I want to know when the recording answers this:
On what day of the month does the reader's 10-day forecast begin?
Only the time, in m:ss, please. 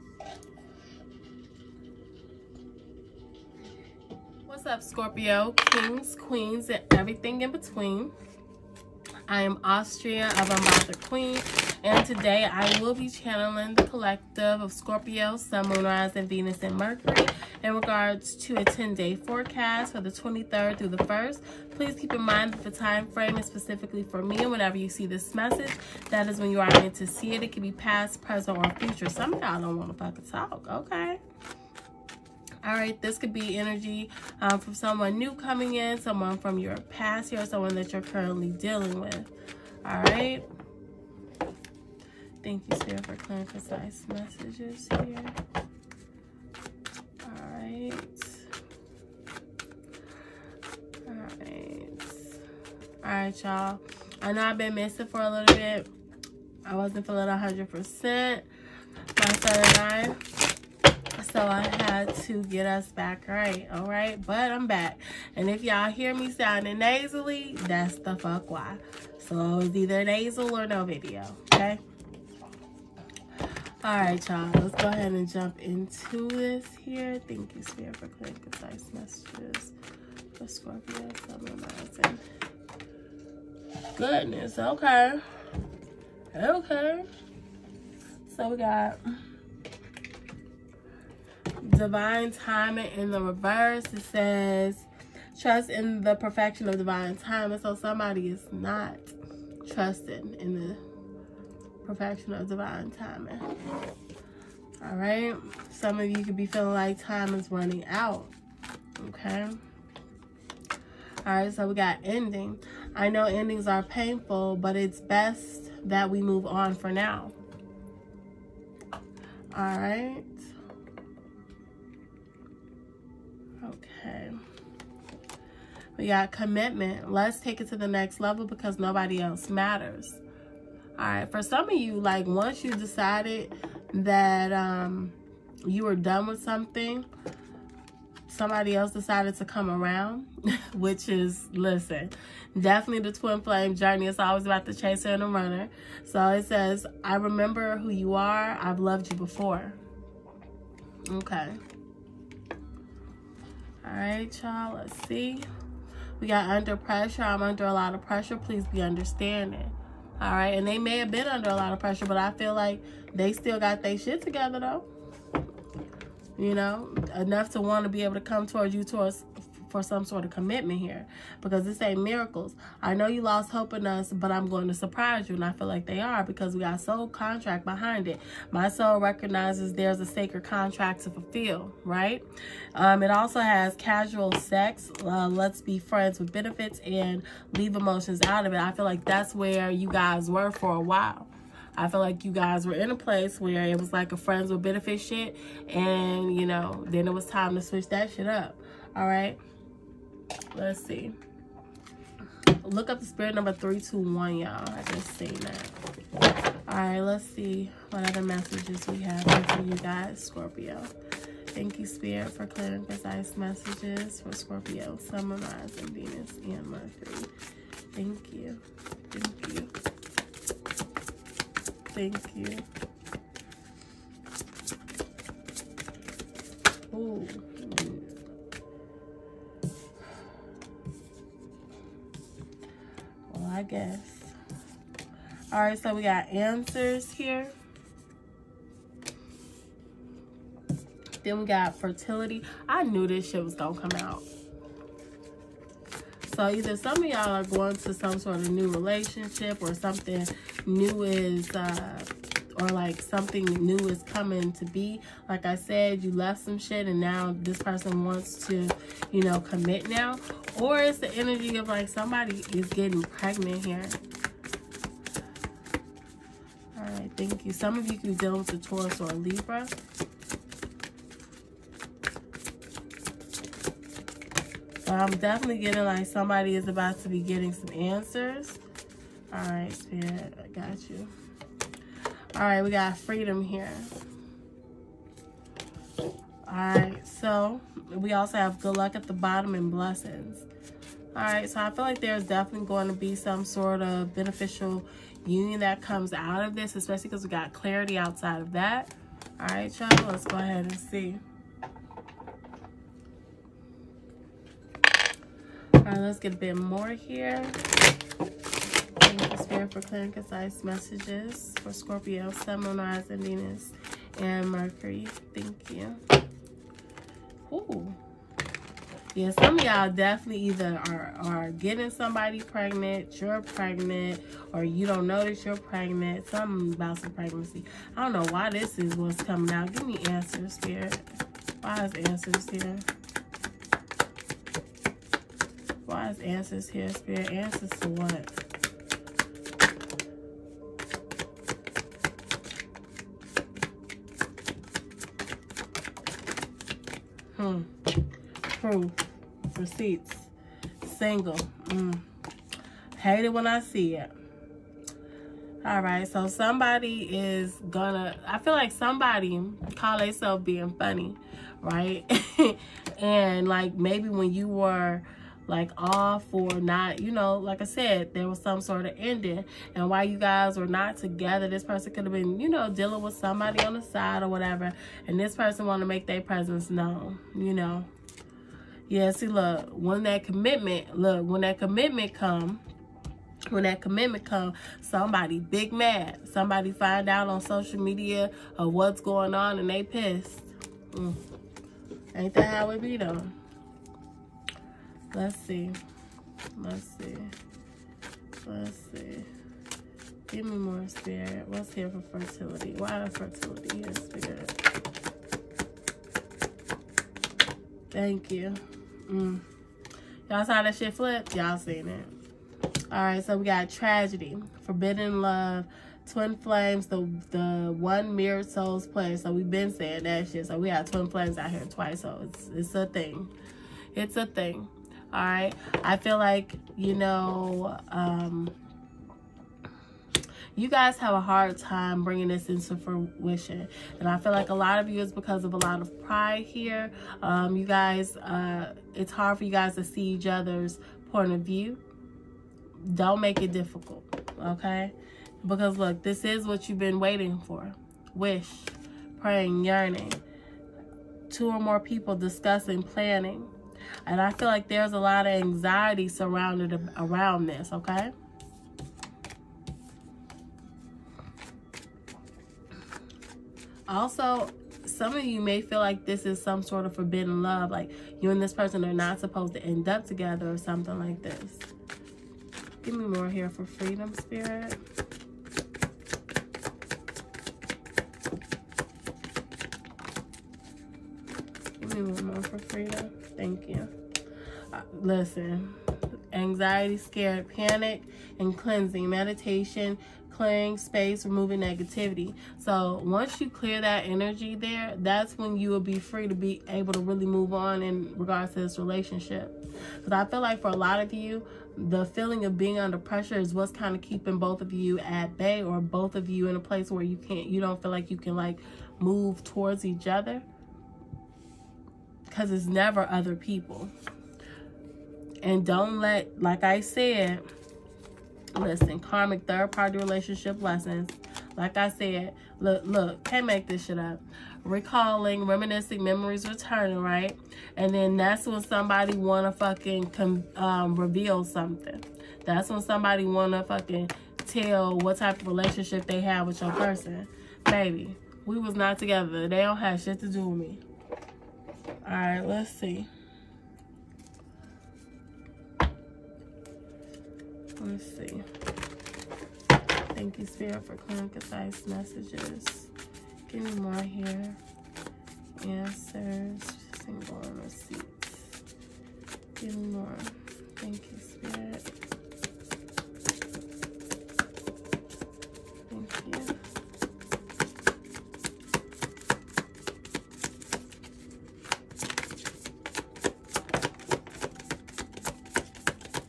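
0:20.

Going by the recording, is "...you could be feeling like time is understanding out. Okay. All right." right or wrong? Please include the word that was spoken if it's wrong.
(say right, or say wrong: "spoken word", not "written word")
wrong: "running", not "understanding".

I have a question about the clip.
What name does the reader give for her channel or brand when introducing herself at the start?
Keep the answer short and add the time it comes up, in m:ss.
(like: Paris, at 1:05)
Unbothered Queen, at 0:10.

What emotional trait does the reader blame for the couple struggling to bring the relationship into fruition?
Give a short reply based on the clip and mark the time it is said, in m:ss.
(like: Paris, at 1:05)
pride, at 7:16.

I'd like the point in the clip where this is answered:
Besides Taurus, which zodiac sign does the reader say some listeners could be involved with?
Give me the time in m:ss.
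4:29.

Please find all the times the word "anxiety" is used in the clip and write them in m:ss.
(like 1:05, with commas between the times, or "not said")
7:35, 8:06.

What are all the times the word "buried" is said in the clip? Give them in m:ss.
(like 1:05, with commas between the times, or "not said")
not said.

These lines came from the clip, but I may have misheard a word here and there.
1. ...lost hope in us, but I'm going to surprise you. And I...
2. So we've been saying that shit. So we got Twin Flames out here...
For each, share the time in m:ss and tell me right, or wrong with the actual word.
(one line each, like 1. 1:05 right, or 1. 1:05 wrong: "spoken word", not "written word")
1. 2:53 right
2. 6:59 right.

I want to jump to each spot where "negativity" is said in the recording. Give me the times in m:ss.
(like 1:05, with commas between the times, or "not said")
8:11.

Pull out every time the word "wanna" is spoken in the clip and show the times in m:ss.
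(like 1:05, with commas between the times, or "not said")
8:49, 8:53.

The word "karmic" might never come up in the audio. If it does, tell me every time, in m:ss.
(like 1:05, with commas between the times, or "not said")
8:38.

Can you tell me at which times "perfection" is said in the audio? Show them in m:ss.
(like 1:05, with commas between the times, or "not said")
1:36, 1:41.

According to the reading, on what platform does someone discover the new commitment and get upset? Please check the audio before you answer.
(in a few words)
social media.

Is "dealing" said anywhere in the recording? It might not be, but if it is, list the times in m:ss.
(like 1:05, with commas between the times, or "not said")
0:38, 6:12.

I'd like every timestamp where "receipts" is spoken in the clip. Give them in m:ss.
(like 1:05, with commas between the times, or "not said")
5:49, 9:17.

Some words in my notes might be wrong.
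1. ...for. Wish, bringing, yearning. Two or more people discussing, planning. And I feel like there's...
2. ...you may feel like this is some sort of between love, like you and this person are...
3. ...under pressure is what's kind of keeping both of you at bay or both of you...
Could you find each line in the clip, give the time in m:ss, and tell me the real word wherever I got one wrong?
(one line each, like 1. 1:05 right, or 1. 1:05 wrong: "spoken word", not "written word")
1. 7:27 wrong: "praying", not "bringing"
2. 7:45 wrong: "forbidden", not "between"
3. 8:22 right.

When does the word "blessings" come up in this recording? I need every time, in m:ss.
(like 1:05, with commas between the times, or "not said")
4:49.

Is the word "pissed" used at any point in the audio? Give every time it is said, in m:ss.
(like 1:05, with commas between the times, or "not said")
6:29.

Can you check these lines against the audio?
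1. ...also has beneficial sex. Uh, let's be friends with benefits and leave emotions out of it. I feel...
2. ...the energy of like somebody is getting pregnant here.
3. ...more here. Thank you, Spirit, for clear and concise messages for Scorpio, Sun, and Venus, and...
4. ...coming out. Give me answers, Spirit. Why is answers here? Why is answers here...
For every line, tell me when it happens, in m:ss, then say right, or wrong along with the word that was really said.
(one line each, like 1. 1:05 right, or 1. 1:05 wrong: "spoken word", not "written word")
1. 3:03 wrong: "casual", not "beneficial"
2. 4:20 right
3. 5:06 right
4. 5:29 right.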